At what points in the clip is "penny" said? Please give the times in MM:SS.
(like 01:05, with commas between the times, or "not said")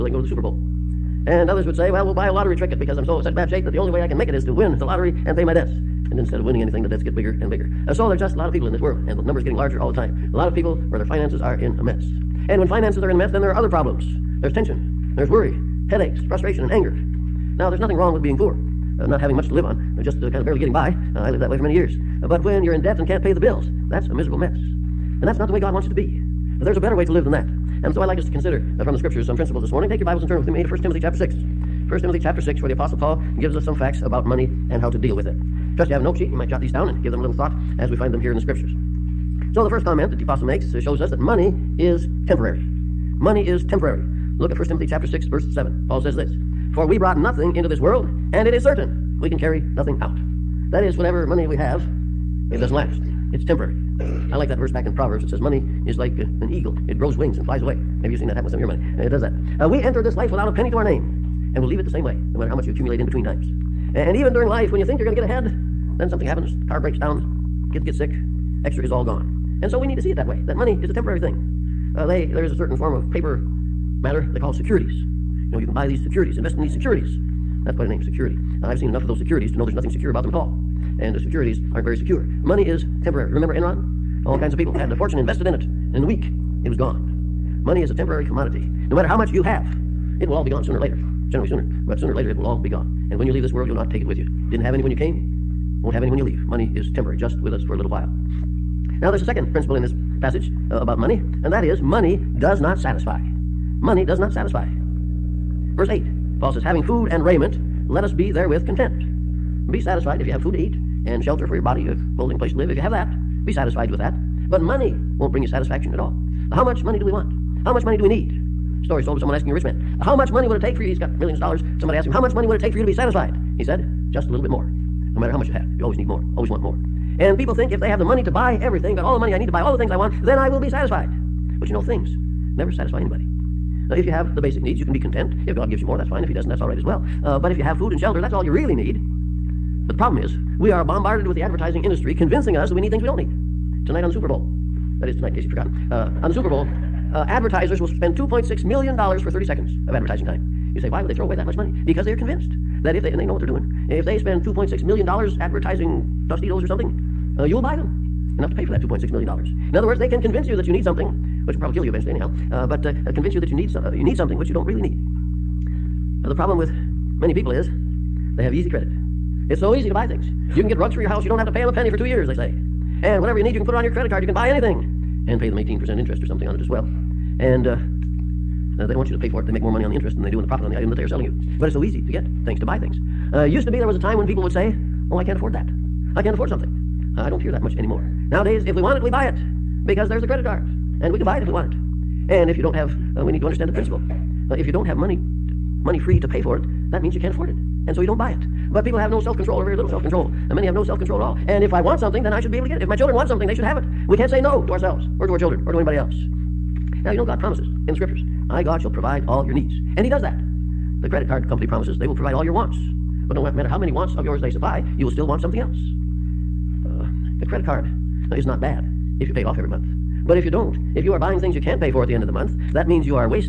01:00, 02:51.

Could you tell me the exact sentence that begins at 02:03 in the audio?
He said, Just a little bit more.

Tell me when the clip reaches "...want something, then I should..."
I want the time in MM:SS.
03:21.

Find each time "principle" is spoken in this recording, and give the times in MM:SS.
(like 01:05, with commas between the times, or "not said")
00:29, 01:39, 03:13.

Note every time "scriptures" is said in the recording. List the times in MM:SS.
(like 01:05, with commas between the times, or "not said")
00:28, 00:38, 03:27.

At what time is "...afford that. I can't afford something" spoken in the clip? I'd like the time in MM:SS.
03:05.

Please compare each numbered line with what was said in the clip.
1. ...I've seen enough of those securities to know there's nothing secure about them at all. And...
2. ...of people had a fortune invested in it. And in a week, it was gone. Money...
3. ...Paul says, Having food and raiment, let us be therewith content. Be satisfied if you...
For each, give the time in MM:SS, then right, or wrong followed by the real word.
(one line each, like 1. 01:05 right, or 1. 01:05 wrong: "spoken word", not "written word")
1. 01:18 right
2. 01:24 right
3. 01:46 right.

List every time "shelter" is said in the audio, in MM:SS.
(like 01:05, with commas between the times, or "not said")
01:51, 02:17.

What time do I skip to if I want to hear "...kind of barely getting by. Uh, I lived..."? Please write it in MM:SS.
00:20.